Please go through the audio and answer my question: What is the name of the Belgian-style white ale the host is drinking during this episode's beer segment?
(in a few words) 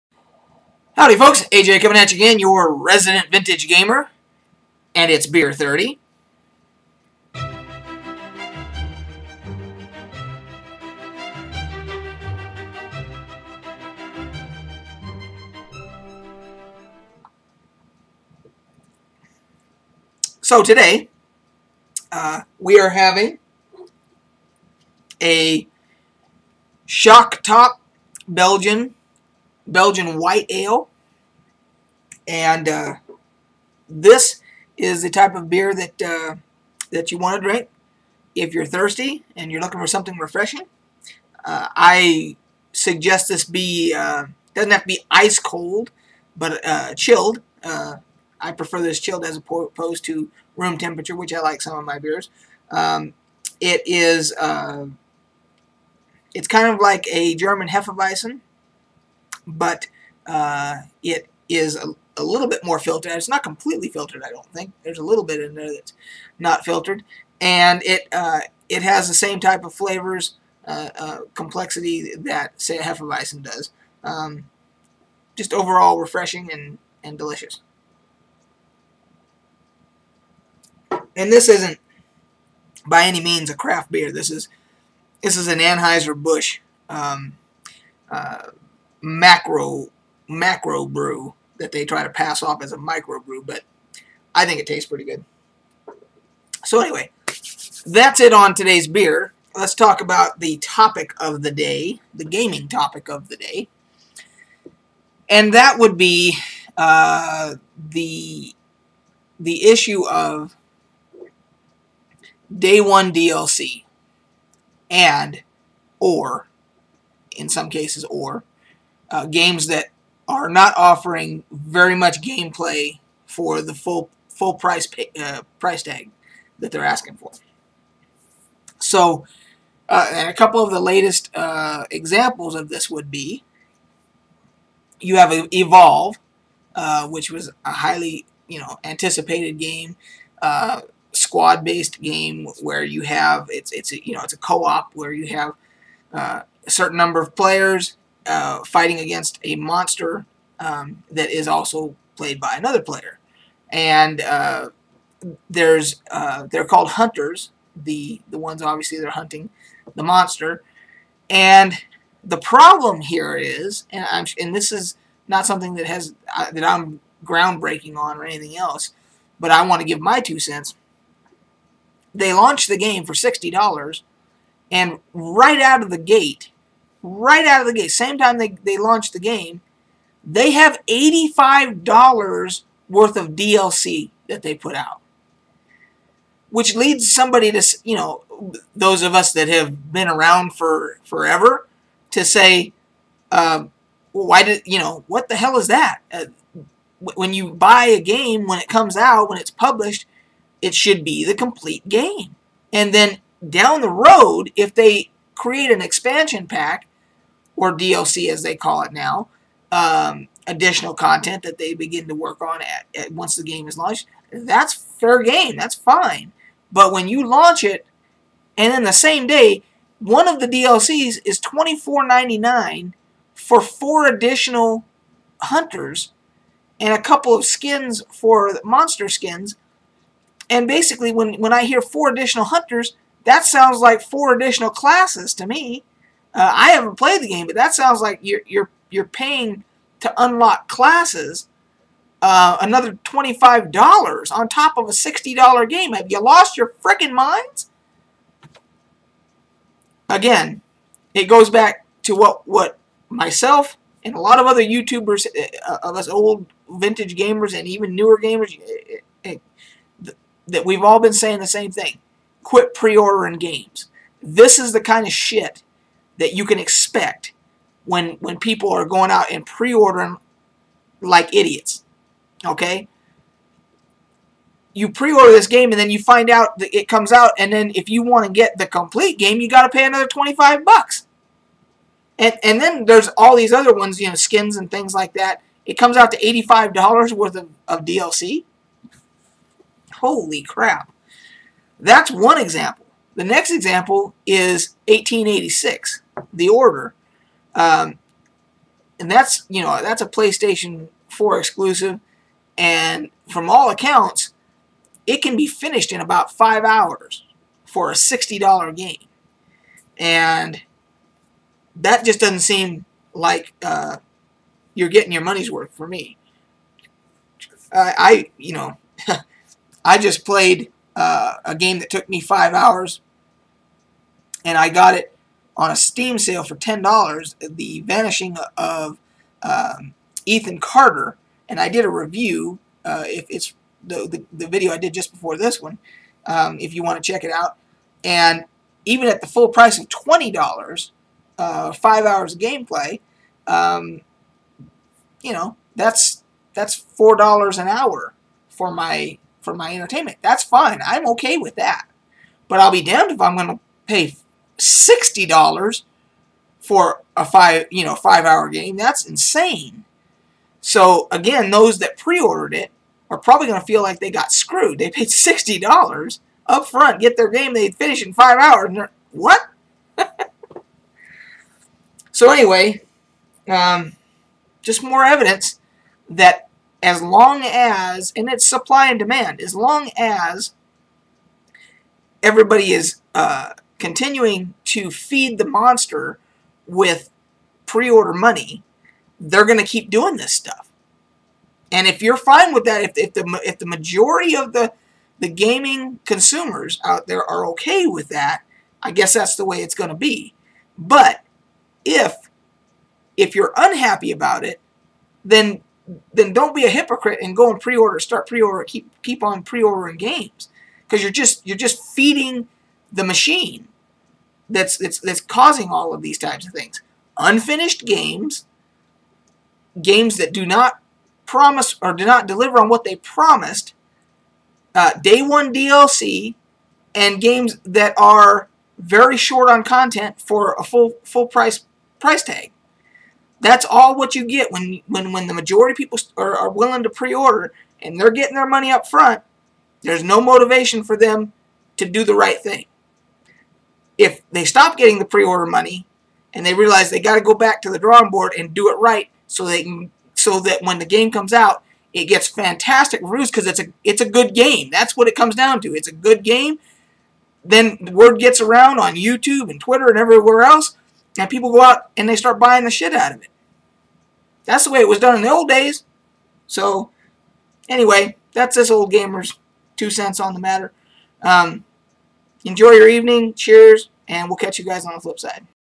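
Shock Top.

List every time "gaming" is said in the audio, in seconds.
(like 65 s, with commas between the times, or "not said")
102 s, 395 s.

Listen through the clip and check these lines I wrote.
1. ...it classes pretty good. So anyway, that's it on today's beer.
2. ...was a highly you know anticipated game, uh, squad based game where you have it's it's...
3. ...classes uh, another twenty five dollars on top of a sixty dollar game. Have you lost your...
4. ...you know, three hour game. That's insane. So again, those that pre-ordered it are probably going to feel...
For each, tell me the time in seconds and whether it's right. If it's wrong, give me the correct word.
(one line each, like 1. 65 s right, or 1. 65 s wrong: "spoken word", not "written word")
1. 94 s wrong: "tastes", not "classes"
2. 137 s right
3. 240 s right
4. 357 s wrong: "five", not "three".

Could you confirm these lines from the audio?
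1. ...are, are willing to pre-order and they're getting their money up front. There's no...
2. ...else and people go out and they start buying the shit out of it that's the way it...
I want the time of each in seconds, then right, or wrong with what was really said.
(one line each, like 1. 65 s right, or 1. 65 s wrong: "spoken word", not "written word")
1. 436 s right
2. 460 s right.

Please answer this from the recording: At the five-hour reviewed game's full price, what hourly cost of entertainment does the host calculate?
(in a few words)
$4 an hour.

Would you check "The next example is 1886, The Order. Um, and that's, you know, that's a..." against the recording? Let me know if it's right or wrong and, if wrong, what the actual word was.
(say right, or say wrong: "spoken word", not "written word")
right.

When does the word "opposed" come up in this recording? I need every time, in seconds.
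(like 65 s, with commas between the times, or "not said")
49 s.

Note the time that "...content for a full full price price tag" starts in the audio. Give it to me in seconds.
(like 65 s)
429 s.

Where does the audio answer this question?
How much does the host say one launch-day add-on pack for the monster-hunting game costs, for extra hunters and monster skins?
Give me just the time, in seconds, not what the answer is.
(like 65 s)
221 s.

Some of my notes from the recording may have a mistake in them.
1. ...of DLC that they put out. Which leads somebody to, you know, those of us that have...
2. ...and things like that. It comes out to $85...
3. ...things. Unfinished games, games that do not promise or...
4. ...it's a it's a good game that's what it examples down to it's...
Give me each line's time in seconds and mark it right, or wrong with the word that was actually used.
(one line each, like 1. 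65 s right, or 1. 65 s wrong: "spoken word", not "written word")
1. 183 s right
2. 284 s right
3. 416 s right
4. 453 s wrong: "comes", not "examples".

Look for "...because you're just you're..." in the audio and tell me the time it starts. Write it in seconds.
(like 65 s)
410 s.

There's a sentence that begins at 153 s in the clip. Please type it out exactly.
And uh, there's uh, they're called hunters.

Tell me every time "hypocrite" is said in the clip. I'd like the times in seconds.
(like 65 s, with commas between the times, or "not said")
406 s.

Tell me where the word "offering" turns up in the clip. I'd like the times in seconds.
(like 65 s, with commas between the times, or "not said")
120 s.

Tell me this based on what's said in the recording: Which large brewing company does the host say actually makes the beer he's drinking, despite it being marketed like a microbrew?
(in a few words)
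Anheuser-Busch.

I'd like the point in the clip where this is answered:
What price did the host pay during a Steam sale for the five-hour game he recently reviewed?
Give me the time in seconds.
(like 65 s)
326 s.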